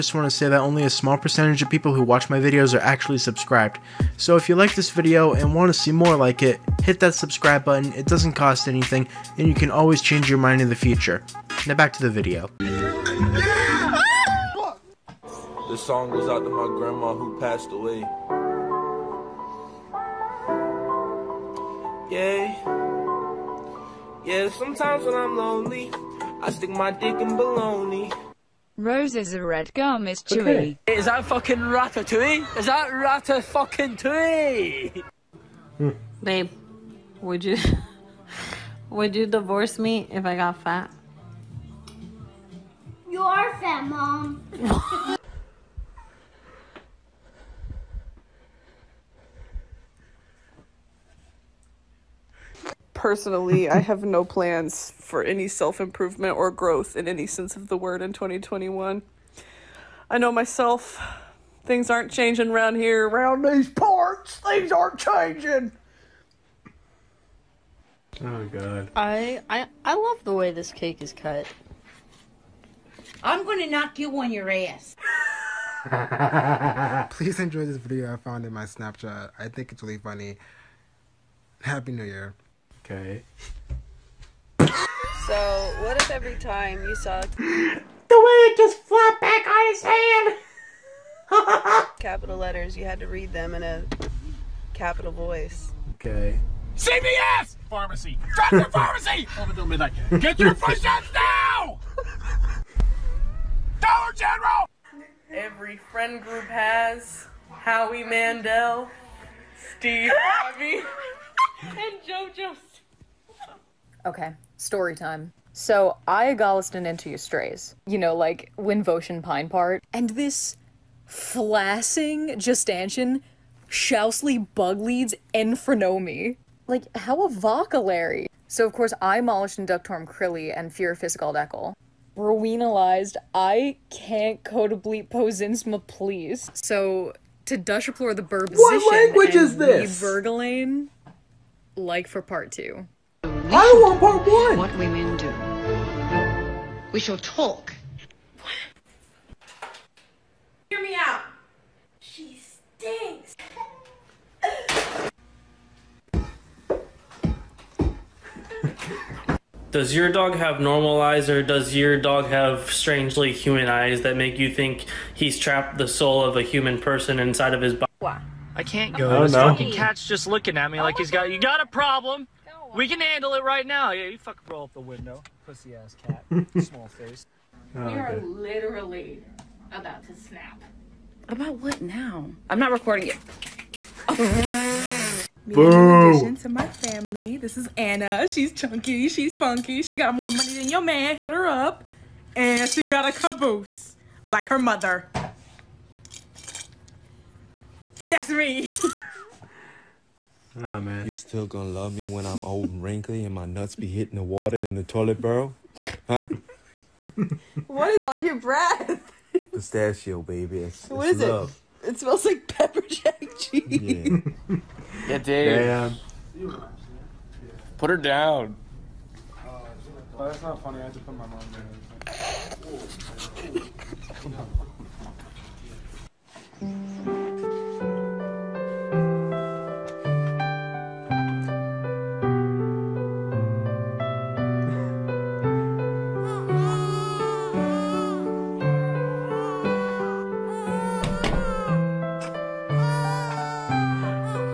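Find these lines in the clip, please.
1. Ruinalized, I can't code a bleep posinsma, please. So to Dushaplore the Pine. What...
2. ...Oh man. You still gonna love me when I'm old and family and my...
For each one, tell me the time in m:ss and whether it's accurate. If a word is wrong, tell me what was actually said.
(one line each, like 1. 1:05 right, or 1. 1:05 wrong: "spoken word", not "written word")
1. 2:12 wrong: "Burbs", not "Pine"
2. 3:20 wrong: "wrinkly", not "family".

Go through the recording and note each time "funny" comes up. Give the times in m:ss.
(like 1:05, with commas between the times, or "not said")
1:19, 3:40.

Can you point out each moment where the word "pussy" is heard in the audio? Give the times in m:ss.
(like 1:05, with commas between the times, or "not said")
2:55.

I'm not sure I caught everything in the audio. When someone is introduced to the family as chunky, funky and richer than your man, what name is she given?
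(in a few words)
Anna.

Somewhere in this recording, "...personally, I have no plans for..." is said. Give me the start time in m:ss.
0:53.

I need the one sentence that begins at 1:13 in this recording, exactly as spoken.
I'm going to knock you on your ass.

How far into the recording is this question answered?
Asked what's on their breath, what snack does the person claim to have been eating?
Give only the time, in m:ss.
3:29.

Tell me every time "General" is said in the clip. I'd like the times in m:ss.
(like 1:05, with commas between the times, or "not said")
1:44.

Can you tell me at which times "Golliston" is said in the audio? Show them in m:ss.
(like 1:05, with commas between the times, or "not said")
1:56.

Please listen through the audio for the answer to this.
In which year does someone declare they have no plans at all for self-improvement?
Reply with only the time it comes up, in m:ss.
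0:58.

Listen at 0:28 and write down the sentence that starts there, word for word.
Roses are red, gum is chewy.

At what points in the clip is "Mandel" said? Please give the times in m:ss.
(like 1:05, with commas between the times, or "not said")
1:48.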